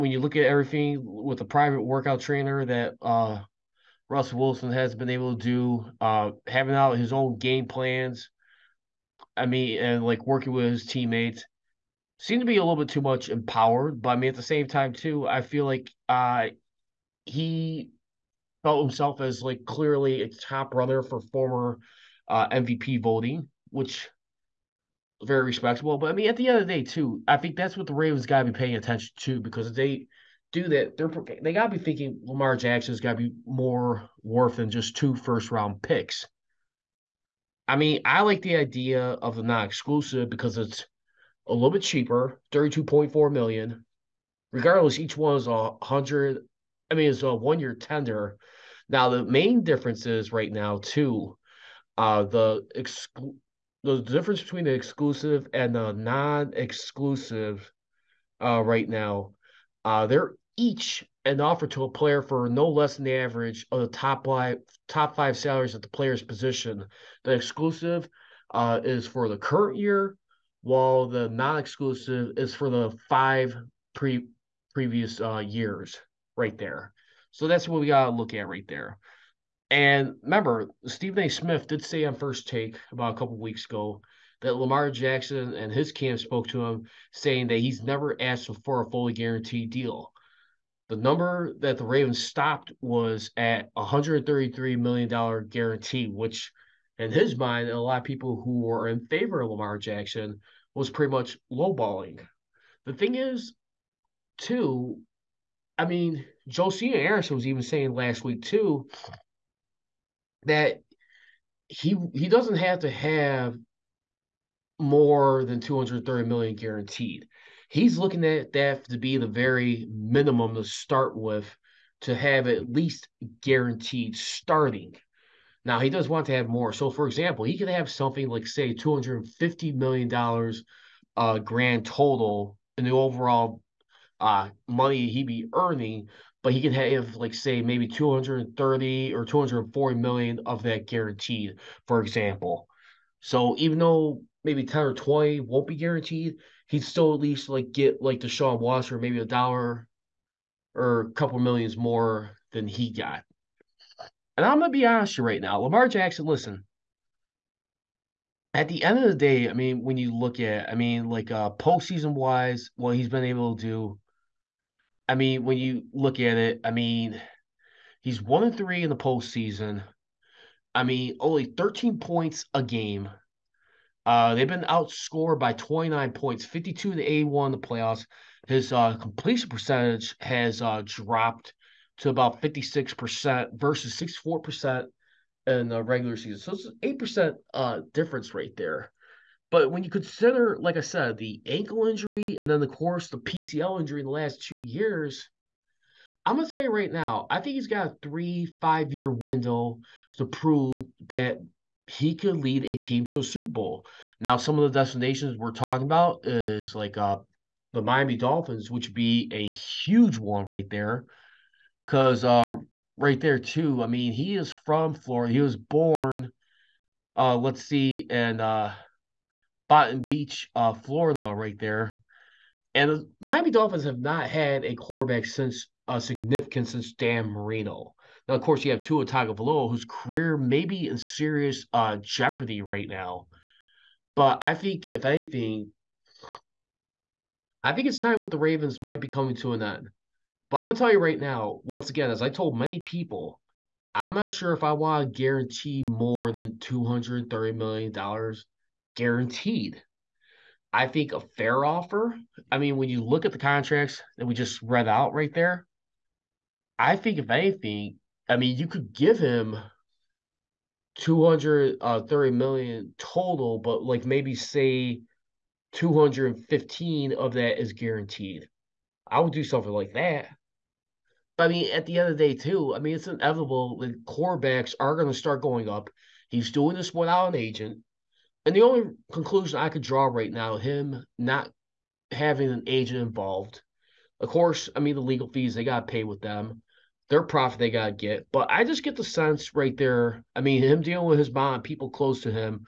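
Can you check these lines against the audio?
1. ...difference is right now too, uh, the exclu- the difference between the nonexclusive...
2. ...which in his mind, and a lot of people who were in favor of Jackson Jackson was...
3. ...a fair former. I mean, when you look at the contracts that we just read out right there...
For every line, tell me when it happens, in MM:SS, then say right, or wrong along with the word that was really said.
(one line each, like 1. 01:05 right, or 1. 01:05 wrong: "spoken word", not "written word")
1. 00:49 wrong: "exclusive", not "nonexclusive"
2. 01:36 wrong: "Lamar", not "Jackson"
3. 04:11 wrong: "offer", not "former".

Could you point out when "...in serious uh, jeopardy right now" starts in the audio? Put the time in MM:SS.
03:50.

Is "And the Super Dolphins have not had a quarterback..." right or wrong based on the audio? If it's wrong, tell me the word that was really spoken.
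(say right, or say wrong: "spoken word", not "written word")
wrong: "Miami", not "Super".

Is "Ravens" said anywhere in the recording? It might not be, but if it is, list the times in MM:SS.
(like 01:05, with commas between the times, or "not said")
00:27, 01:31, 03:58.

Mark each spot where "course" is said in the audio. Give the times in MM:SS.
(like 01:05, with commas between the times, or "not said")
03:12, 03:48, 04:44.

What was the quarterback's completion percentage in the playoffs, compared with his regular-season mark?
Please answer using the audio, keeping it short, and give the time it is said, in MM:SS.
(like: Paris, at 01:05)
56%, at 03:02.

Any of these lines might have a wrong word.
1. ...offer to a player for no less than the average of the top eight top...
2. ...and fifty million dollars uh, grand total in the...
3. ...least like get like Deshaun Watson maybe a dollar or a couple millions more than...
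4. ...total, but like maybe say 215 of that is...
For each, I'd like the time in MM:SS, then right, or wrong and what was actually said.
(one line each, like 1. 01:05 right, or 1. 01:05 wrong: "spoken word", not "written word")
1. 01:01 wrong: "five", not "eight"
2. 02:09 right
3. 02:27 right
4. 04:22 right.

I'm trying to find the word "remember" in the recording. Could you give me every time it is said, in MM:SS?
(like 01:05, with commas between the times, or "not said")
01:20.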